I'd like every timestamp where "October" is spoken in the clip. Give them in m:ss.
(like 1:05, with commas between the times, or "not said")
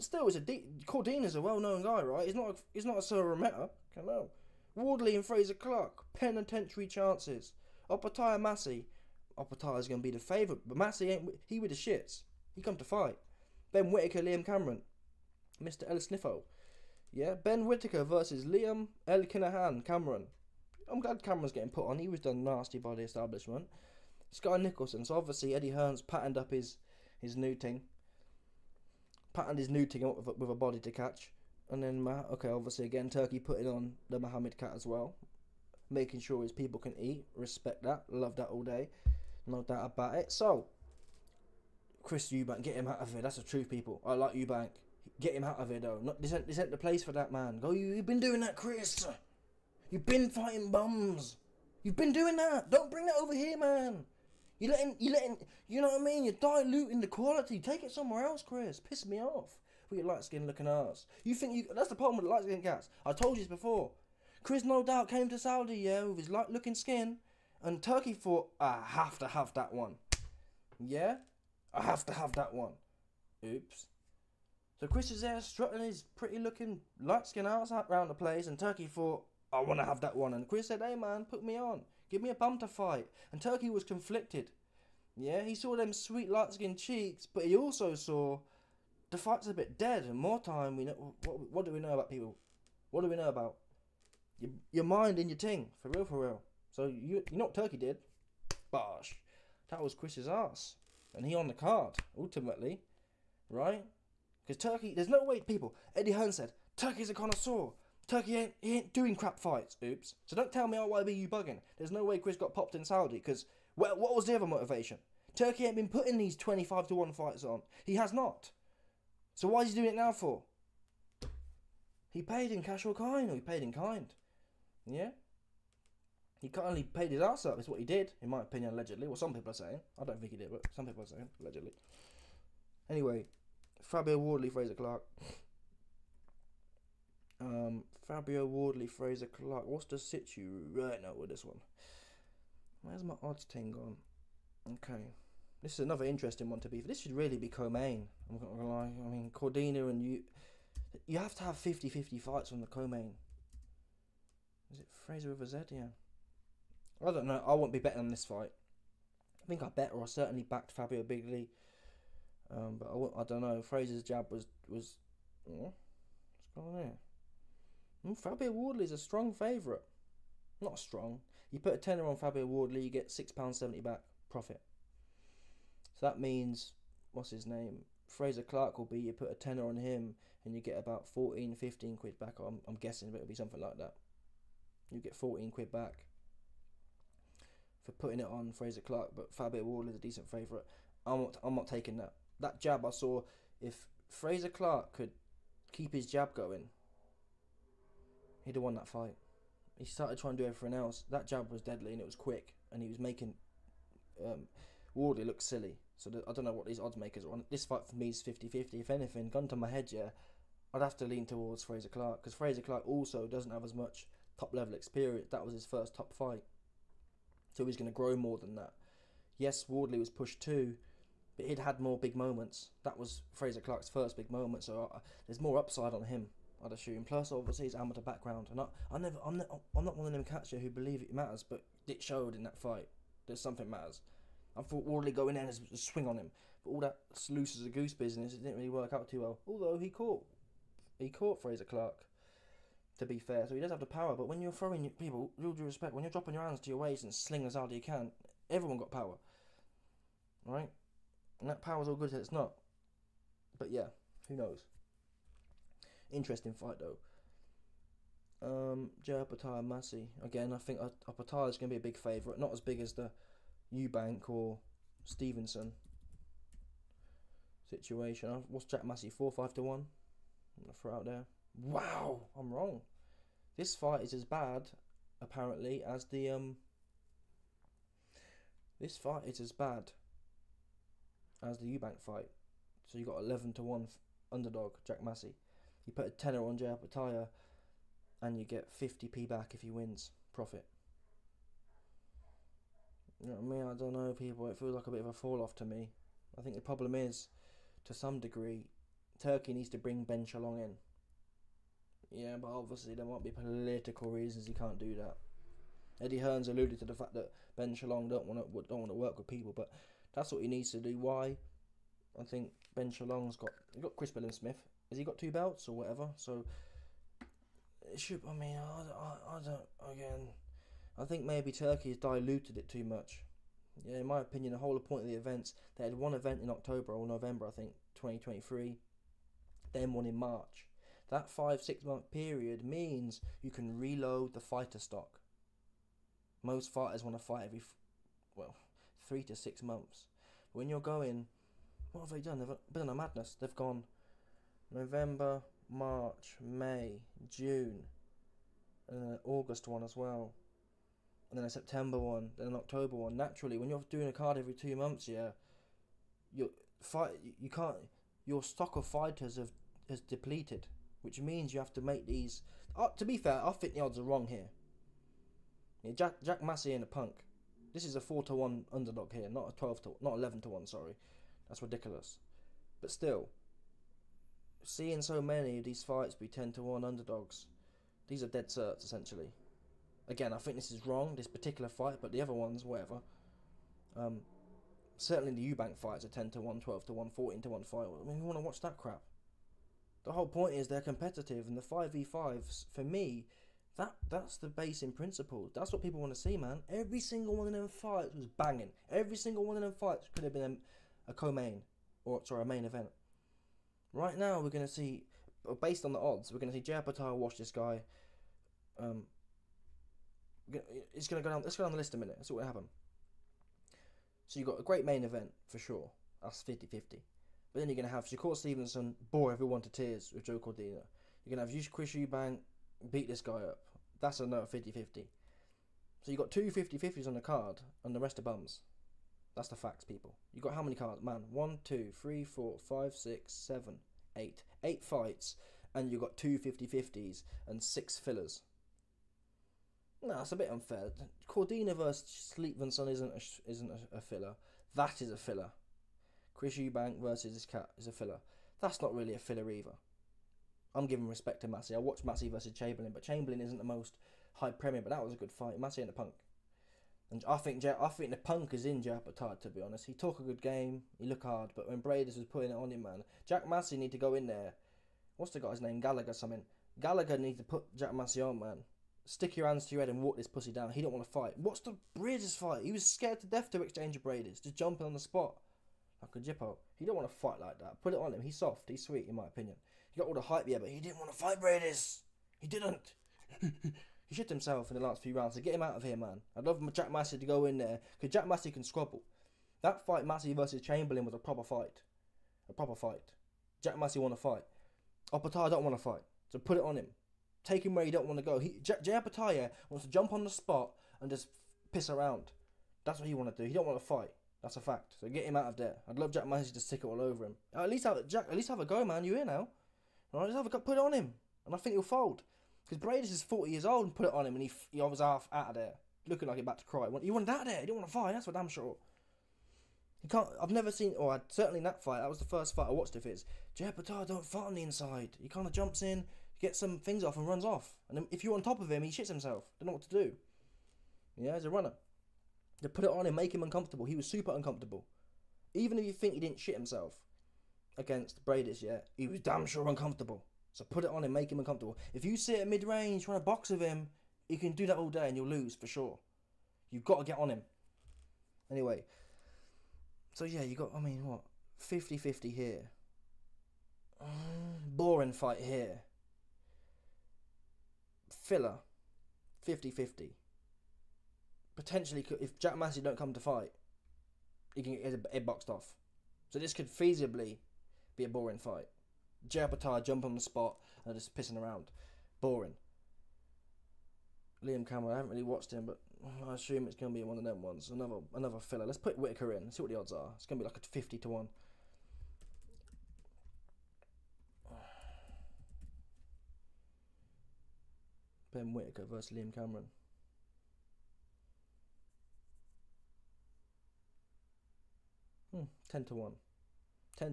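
5:26, 5:52.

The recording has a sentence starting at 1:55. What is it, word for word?
Turki ain't been putting these 25 to 1 fights on.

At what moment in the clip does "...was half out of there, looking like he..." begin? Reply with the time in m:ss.
8:34.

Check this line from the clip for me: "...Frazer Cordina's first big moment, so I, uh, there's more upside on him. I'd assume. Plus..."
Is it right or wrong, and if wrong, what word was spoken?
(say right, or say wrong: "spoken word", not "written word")
wrong: "Clarke", not "Cordina".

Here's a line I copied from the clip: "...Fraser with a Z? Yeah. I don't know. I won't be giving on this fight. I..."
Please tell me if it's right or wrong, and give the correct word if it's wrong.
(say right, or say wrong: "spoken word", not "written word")
wrong: "betting", not "giving".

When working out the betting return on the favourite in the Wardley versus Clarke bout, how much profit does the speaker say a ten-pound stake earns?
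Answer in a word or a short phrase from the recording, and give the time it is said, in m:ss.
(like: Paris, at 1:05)
£6.70, at 2:53.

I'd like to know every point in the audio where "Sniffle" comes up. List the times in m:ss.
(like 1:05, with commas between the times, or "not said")
0:16.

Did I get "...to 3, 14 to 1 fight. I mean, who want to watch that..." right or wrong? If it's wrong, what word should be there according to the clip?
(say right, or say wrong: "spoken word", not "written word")
wrong: "1", not "3".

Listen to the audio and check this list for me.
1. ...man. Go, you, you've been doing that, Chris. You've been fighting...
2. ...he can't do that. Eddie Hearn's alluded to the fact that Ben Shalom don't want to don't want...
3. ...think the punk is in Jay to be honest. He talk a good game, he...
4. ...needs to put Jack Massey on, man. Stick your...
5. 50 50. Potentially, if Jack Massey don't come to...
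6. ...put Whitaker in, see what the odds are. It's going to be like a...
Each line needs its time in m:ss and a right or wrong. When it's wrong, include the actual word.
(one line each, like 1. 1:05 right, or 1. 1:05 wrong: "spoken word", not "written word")
1. 0:47 right
2. 5:04 right
3. 7:37 wrong: "Joe", not "Jay"
4. 7:47 right
5. 9:19 right
6. 9:38 right.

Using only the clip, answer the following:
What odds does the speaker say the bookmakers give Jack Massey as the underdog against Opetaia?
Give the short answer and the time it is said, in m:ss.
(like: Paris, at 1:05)
11 to 1, at 4:43.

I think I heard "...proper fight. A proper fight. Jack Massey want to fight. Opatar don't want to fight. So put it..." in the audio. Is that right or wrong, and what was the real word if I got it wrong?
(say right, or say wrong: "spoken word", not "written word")
right.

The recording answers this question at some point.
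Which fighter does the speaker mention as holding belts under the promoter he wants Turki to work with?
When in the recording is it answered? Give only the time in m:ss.
5:13.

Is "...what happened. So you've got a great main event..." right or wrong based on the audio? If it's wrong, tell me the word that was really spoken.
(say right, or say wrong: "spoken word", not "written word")
right.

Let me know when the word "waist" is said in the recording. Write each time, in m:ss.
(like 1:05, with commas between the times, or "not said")
4:06.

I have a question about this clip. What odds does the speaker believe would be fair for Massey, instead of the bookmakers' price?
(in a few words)
4 to 1.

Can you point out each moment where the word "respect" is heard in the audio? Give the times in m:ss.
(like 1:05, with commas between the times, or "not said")
0:37, 4:05, 7:31.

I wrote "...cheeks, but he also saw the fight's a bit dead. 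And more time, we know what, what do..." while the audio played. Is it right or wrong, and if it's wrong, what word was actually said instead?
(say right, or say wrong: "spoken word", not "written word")
right.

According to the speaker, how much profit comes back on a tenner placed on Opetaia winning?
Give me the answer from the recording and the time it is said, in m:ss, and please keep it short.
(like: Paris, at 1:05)
50p, at 4:48.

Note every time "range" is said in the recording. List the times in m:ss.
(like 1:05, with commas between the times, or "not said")
9:02.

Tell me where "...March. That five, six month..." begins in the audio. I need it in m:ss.
5:30.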